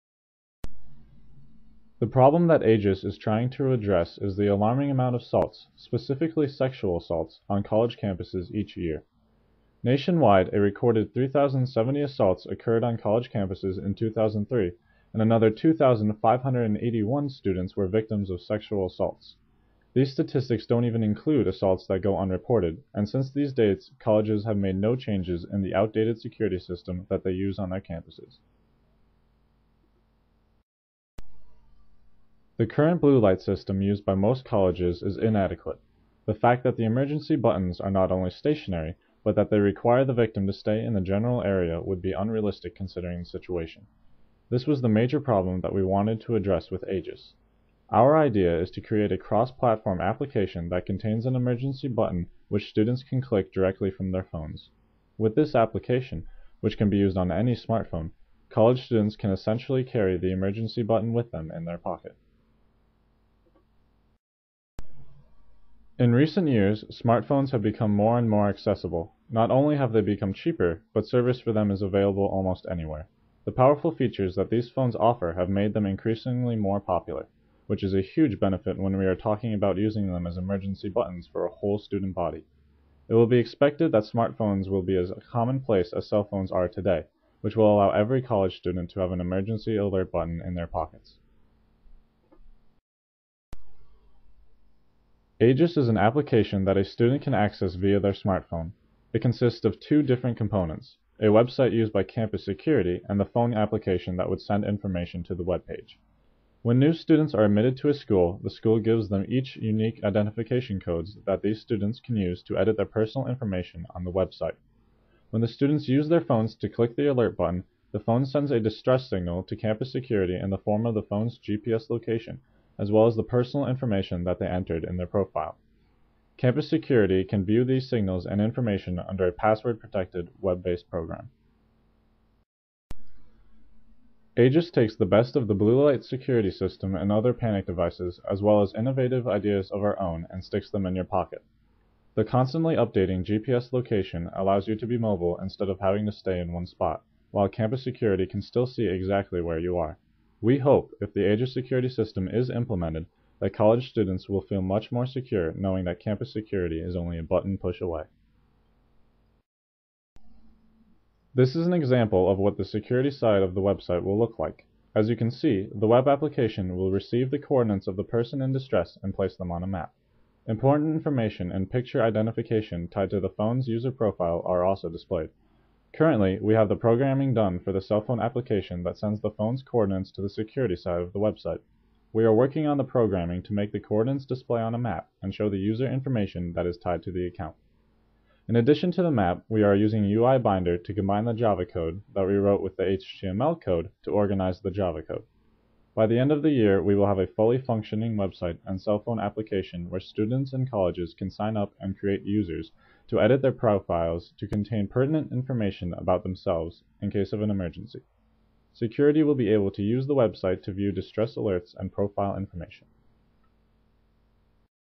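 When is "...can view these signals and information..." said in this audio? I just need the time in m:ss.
2:07.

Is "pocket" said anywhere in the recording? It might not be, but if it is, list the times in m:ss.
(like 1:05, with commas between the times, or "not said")
1:01, 1:30, 2:21.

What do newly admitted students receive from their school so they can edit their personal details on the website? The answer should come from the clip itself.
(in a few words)
unique identification codes.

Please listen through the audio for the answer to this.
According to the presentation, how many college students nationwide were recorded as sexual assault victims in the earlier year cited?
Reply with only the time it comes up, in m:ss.
0:15.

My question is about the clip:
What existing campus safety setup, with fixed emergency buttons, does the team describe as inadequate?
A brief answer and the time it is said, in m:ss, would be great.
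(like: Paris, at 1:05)
blue light system, at 0:32.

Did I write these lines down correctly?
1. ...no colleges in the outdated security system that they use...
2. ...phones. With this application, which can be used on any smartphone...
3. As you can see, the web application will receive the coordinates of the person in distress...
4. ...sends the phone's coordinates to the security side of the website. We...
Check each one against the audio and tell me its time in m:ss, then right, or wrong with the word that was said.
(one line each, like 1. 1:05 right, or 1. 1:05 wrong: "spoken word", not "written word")
1. 0:24 wrong: "changes", not "colleges"
2. 0:54 right
3. 2:44 right
4. 2:58 right.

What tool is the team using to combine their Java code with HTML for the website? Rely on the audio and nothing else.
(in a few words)
UI Binder.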